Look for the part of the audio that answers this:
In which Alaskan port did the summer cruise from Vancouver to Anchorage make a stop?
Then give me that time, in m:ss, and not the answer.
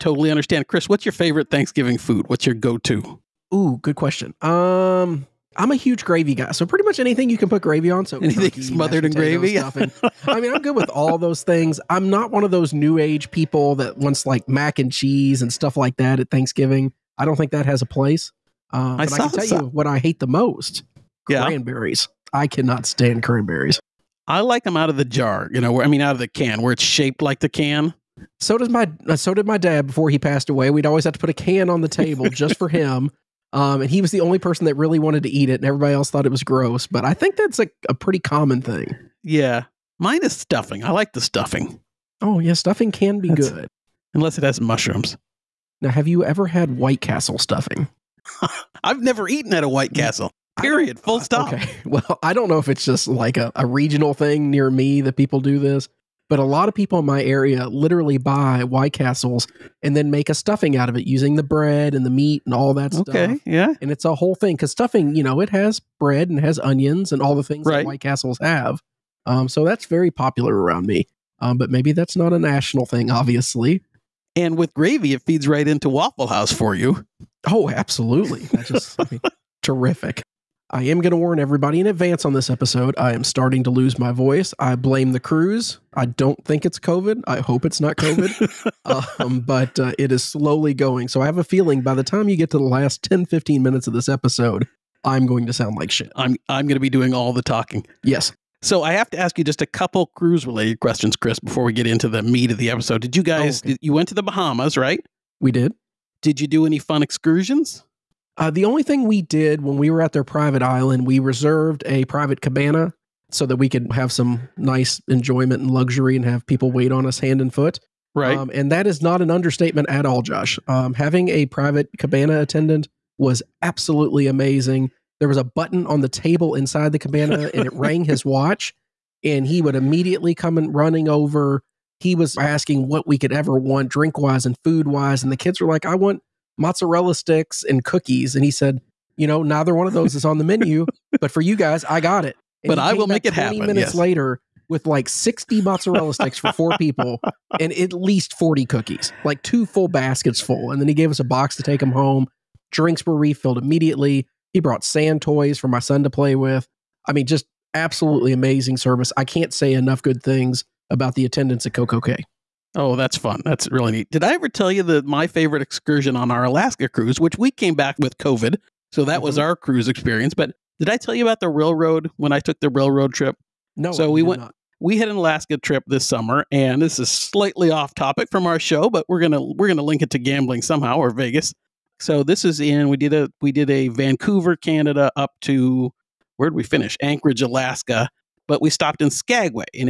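3:09.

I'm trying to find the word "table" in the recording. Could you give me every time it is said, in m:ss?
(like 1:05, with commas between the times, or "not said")
0:31, 2:06.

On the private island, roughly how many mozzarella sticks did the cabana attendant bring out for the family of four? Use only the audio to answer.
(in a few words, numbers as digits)
60.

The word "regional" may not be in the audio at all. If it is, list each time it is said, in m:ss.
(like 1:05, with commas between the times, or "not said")
0:53.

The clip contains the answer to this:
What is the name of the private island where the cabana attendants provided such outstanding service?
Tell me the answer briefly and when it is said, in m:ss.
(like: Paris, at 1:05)
CocoCay, at 2:41.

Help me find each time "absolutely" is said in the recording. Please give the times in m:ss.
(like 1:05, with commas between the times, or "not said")
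1:17, 2:03, 2:37.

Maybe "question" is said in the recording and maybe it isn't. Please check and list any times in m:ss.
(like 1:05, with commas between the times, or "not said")
0:03, 1:40.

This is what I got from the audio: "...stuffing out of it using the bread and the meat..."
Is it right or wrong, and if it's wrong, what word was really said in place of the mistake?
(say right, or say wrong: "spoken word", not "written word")
right.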